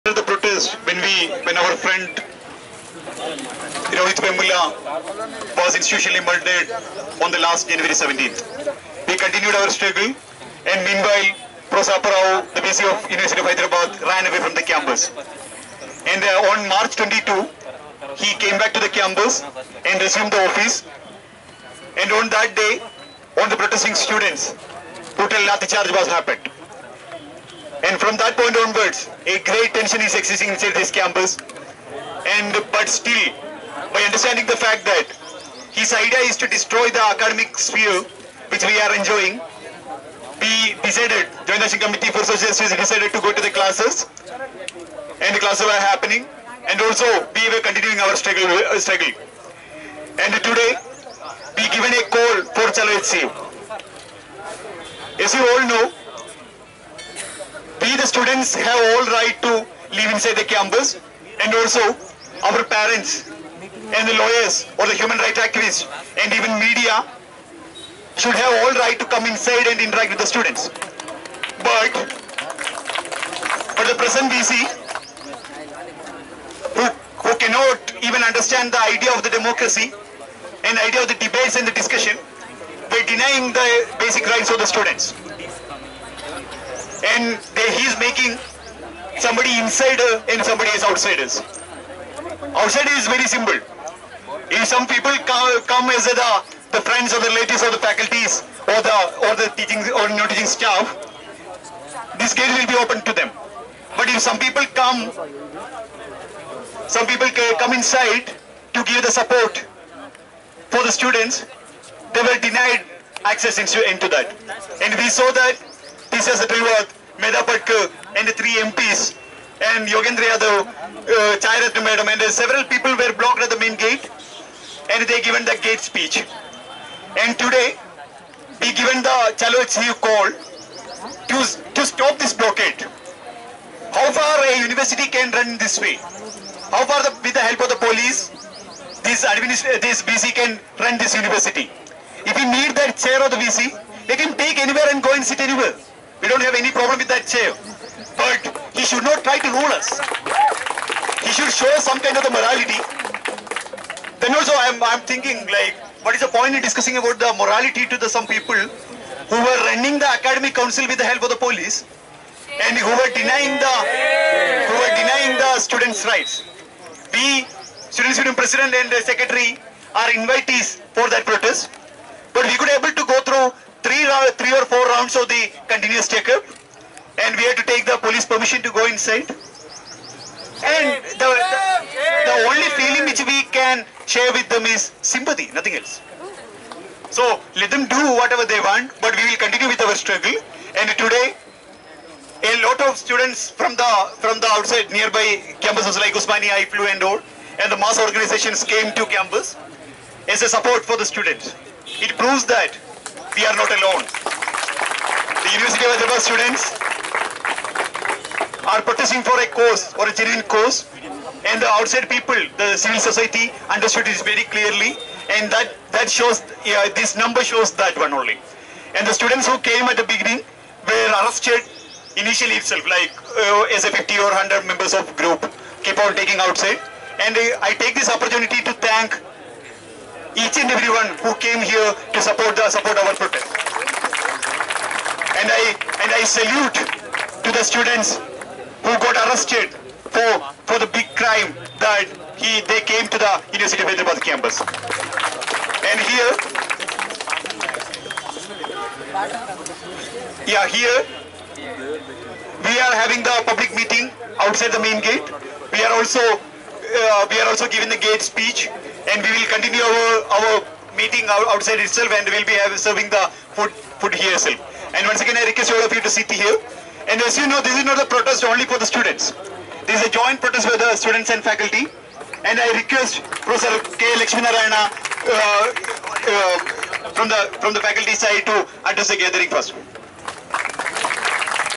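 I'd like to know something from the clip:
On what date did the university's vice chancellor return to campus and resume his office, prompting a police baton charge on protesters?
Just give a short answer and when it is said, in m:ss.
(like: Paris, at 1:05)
March 22, at 0:16.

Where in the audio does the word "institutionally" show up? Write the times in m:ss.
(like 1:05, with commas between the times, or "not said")
0:05.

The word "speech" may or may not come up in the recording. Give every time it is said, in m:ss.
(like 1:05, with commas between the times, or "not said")
2:05, 4:18.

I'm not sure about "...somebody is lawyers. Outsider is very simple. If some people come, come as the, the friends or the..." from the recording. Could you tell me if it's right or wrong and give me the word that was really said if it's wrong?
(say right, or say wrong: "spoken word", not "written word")
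wrong: "outsiders", not "lawyers".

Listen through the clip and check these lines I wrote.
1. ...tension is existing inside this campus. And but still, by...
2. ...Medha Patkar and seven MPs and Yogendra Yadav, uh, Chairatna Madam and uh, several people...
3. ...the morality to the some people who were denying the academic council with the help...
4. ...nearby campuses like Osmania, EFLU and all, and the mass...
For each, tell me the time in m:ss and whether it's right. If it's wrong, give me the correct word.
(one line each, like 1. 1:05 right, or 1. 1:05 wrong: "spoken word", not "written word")
1. 0:29 right
2. 1:57 wrong: "three", not "seven"
3. 2:37 wrong: "running", not "denying"
4. 3:14 right.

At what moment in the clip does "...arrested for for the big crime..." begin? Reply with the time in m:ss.
3:59.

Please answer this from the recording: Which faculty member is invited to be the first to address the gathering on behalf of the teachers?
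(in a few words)
K. Lakshminarayana.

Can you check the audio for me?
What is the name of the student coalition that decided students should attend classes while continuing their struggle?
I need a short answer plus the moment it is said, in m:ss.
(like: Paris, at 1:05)
Joint Action Committee for Social Justice, at 0:41.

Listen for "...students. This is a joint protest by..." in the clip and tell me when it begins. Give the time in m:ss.
4:28.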